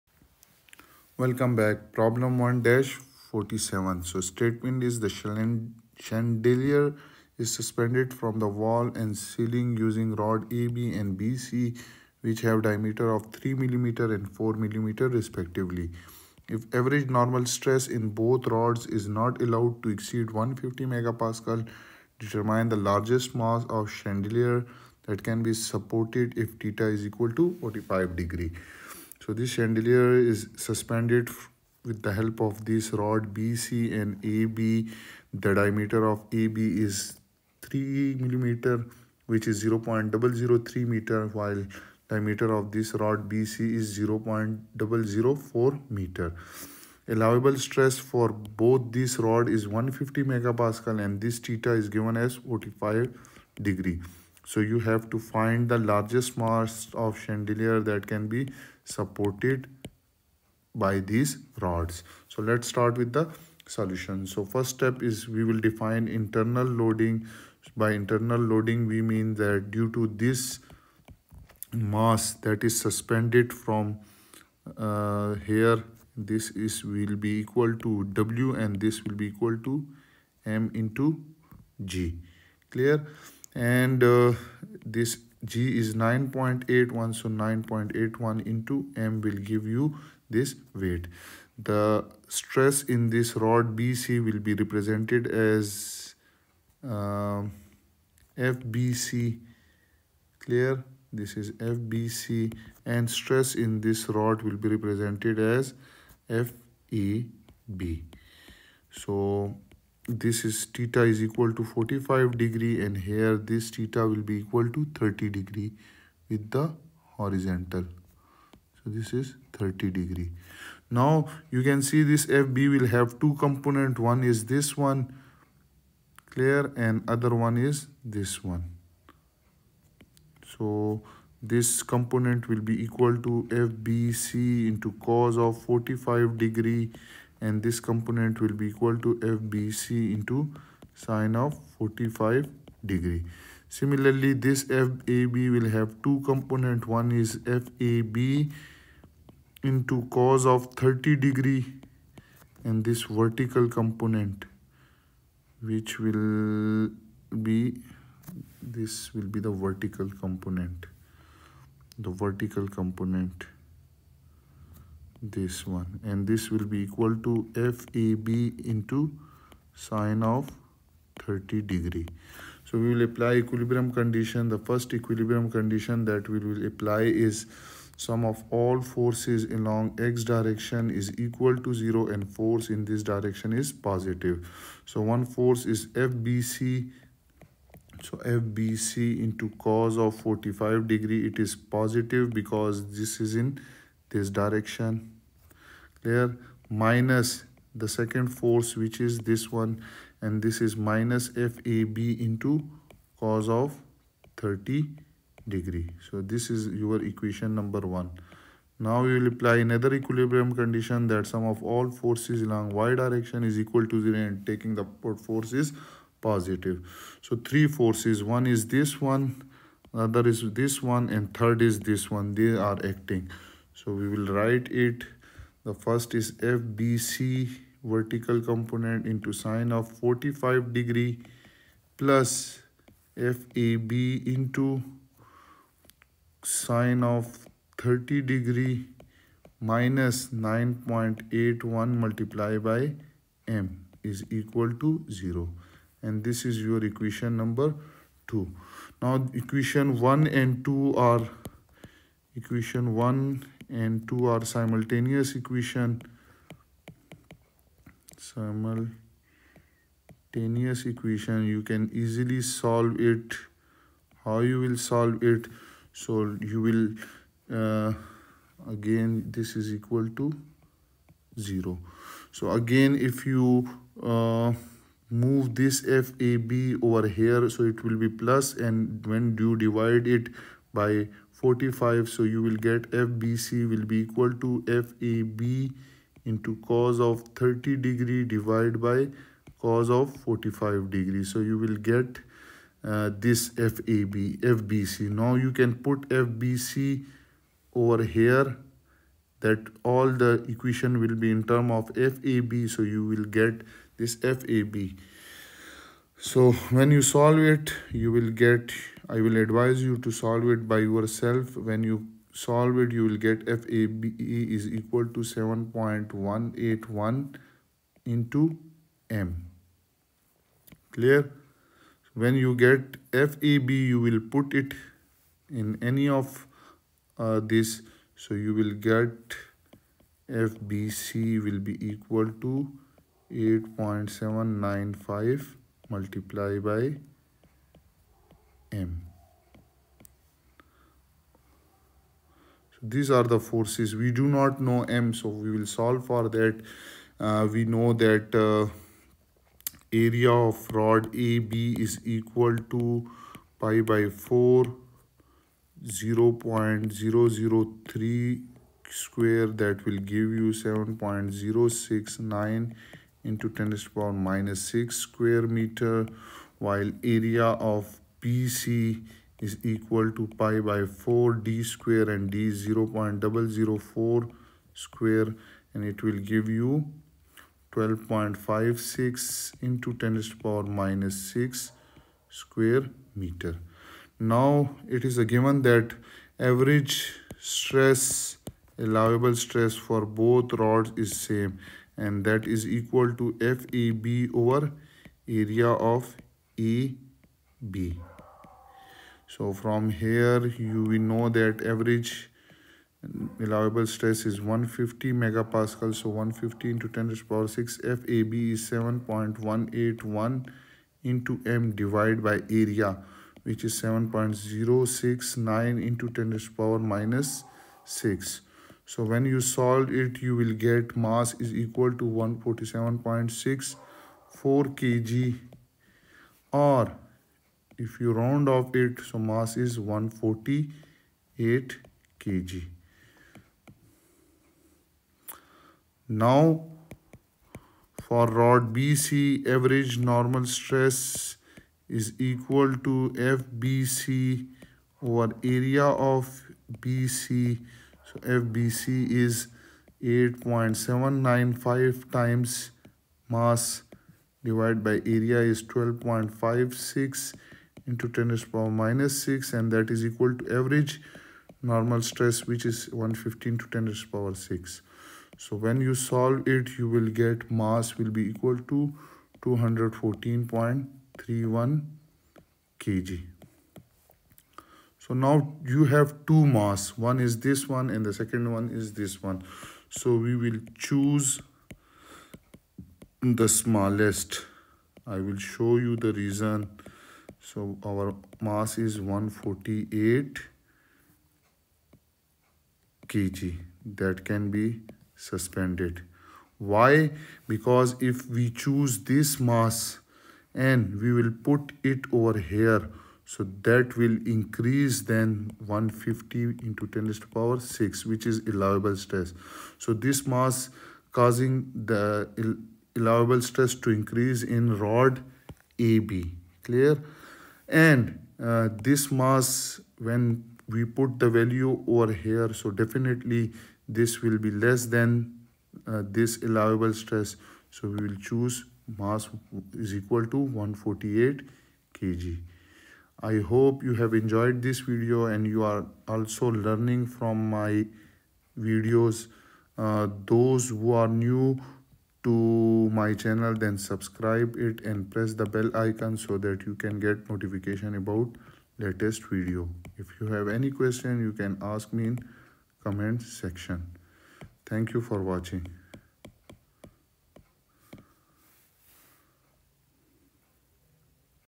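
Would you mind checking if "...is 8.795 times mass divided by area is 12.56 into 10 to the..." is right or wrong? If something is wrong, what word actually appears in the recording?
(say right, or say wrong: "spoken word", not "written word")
right.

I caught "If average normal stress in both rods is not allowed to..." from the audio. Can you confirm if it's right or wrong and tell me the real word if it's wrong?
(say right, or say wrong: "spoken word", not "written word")
right.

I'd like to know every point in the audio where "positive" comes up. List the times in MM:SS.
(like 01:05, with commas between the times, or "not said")
03:03, 03:11, 03:36.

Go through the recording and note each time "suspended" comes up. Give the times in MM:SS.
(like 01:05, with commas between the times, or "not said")
00:07, 00:30, 01:12, 08:15.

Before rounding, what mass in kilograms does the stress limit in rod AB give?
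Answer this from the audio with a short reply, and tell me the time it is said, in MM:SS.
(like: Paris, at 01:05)
147.64 kg, at 07:02.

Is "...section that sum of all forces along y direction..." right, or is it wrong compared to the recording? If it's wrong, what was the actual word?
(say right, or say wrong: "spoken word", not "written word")
wrong: "condition", not "section".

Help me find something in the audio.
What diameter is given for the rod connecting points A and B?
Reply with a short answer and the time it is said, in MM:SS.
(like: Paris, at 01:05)
3 mm, at 00:13.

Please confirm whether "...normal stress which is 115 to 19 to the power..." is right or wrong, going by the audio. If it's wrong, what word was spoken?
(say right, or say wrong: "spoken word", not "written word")
wrong: "10", not "19".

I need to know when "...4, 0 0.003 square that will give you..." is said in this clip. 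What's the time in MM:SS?
05:54.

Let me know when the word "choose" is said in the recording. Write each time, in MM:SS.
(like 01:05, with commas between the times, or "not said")
08:00, 08:18, 08:48.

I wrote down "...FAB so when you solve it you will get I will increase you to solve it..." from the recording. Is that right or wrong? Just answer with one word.
wrong.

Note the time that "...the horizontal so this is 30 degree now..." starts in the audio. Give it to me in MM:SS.
01:56.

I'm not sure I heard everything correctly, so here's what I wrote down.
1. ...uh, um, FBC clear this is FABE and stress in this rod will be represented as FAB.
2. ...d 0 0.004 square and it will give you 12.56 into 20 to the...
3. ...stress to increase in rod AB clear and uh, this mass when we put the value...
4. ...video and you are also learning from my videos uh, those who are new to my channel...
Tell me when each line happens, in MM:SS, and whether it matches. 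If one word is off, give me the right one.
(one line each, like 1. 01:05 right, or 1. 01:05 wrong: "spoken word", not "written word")
1. 01:36 wrong: "FBC", not "FABE"
2. 06:12 wrong: "10", not "20"
3. 08:33 right
4. 08:54 right.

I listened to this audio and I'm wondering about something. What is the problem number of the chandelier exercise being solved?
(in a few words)
1-47.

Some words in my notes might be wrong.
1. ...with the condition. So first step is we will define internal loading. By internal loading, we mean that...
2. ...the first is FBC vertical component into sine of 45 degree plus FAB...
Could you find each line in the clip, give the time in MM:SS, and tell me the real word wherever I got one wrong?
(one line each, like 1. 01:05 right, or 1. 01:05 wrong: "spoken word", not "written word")
1. 01:02 wrong: "solution", not "condition"
2. 03:45 right.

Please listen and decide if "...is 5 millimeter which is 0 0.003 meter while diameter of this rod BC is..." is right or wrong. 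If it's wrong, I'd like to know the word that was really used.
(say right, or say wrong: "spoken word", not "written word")
wrong: "3", not "5".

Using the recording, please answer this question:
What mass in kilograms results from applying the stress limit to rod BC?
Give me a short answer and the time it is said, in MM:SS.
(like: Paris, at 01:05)
214.31 kg, at 07:49.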